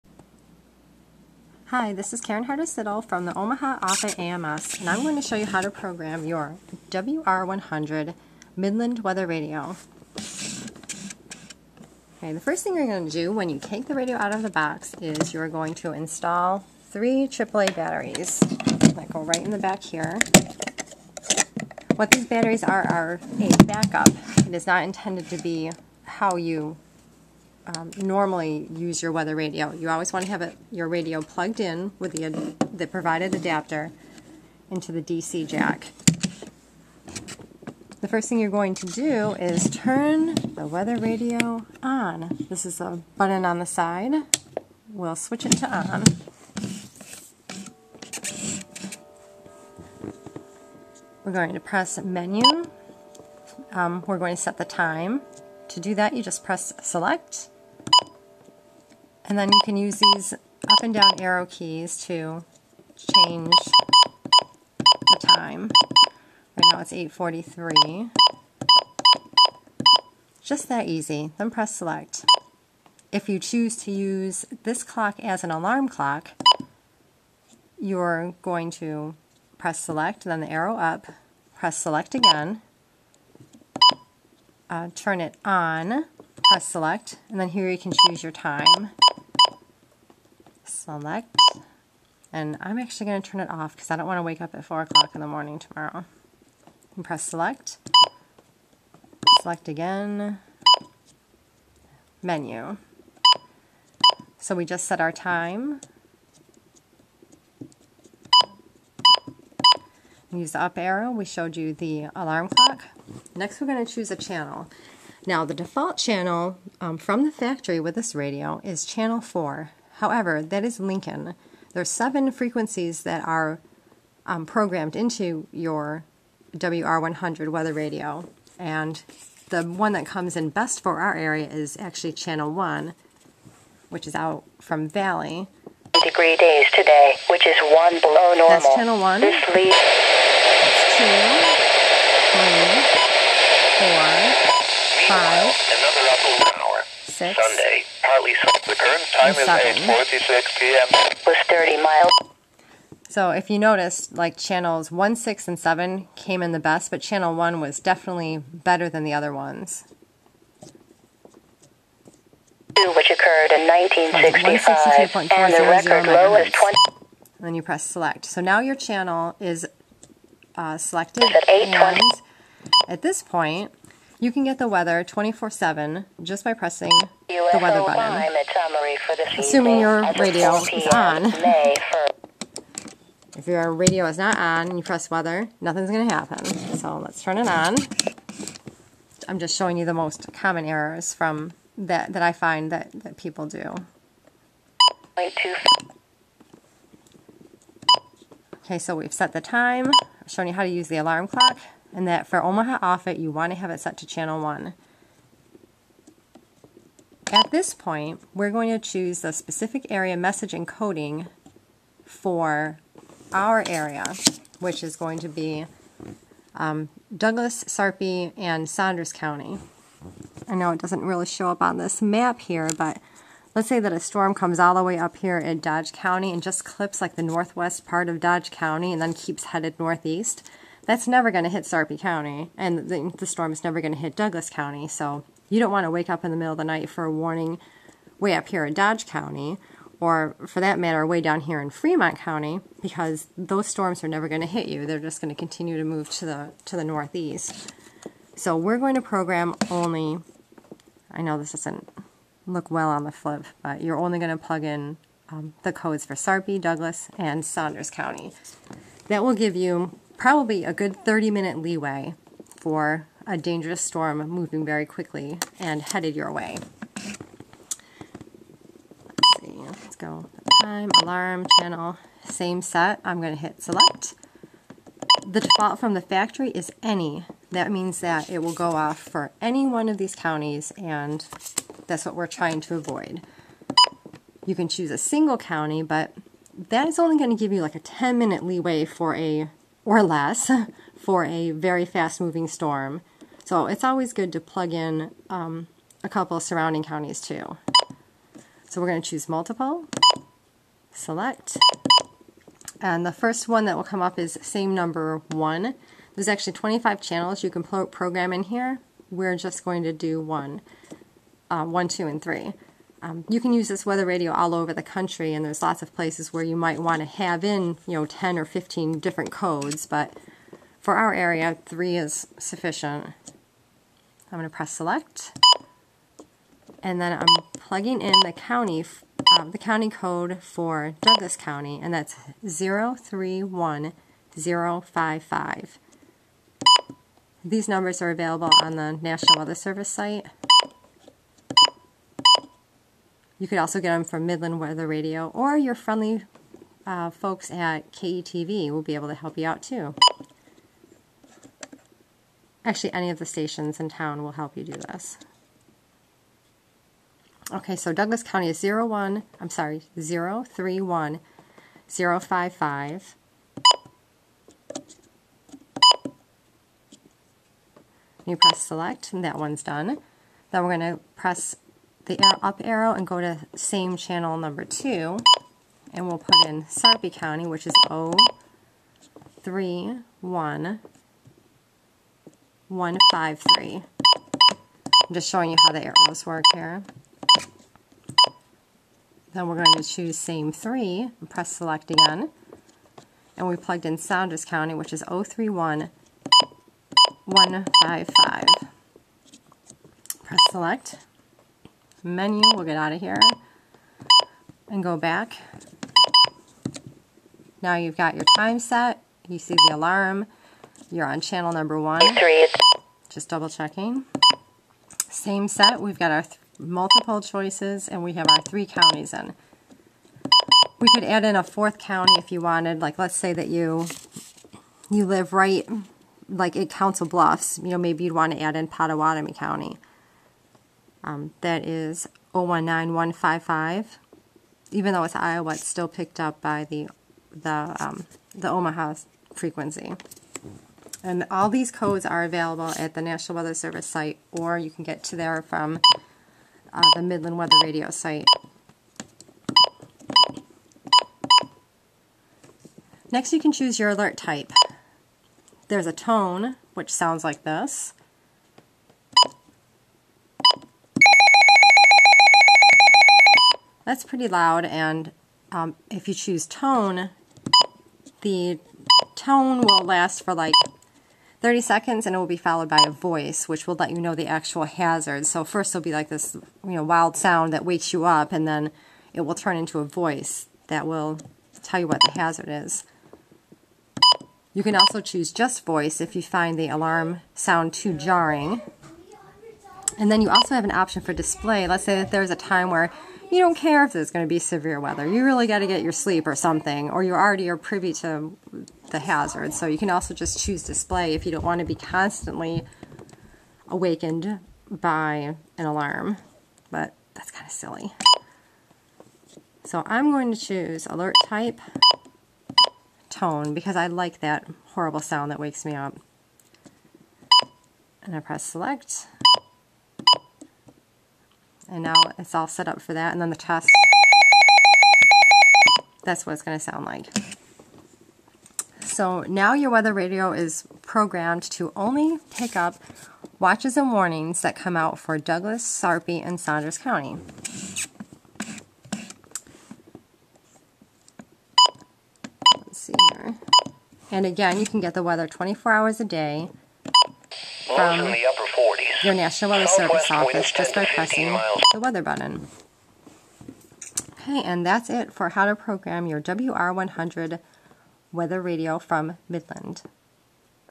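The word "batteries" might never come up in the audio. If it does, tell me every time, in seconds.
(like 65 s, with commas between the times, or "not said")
17 s, 22 s.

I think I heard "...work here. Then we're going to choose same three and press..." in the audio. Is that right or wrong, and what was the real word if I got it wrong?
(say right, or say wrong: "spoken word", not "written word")
right.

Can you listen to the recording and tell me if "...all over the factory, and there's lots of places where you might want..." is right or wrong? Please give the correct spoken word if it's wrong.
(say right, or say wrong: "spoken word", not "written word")
wrong: "country", not "factory".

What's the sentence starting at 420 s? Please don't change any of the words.
We could add in a fourth county if you wanted.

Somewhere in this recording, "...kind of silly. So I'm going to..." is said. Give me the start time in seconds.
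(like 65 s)
507 s.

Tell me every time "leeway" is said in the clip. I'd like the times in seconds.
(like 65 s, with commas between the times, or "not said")
261 s, 288 s.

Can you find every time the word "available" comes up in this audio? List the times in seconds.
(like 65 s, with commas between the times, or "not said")
338 s, 442 s.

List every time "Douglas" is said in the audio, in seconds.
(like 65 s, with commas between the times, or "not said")
217 s, 234 s, 256 s, 331 s, 357 s, 535 s.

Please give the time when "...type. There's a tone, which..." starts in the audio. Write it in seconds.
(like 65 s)
454 s.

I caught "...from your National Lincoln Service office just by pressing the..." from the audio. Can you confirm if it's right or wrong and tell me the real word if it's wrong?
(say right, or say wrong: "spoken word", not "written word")
wrong: "Weather", not "Lincoln".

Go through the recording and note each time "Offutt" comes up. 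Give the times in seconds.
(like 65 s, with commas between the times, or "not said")
3 s, 202 s.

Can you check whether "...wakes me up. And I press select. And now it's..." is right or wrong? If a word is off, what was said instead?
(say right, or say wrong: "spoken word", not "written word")
right.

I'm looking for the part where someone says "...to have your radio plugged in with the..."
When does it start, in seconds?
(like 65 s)
30 s.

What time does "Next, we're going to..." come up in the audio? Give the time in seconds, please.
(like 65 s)
113 s.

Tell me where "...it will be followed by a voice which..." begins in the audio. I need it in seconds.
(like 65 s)
472 s.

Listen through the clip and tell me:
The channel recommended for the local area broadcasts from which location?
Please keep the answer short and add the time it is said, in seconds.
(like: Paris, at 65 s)
Valley, at 134 s.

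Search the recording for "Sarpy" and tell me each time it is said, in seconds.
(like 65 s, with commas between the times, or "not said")
217 s, 231 s, 256 s, 376 s, 535 s.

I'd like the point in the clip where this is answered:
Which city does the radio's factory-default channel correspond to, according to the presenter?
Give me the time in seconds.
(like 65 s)
120 s.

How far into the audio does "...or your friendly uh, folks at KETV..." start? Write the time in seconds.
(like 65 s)
345 s.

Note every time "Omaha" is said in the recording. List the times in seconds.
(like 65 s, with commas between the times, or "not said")
3 s, 202 s, 438 s.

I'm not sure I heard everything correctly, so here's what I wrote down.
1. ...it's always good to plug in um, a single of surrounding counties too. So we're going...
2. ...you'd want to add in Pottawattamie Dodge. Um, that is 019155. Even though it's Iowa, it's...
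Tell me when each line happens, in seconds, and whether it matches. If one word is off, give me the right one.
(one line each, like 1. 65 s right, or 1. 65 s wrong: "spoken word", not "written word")
1. 293 s wrong: "couple", not "single"
2. 428 s wrong: "County", not "Dodge".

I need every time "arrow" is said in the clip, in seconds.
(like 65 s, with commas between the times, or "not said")
61 s, 80 s, 110 s, 372 s, 385 s.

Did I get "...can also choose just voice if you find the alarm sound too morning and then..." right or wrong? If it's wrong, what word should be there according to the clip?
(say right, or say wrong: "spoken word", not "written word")
wrong: "jarring", not "morning".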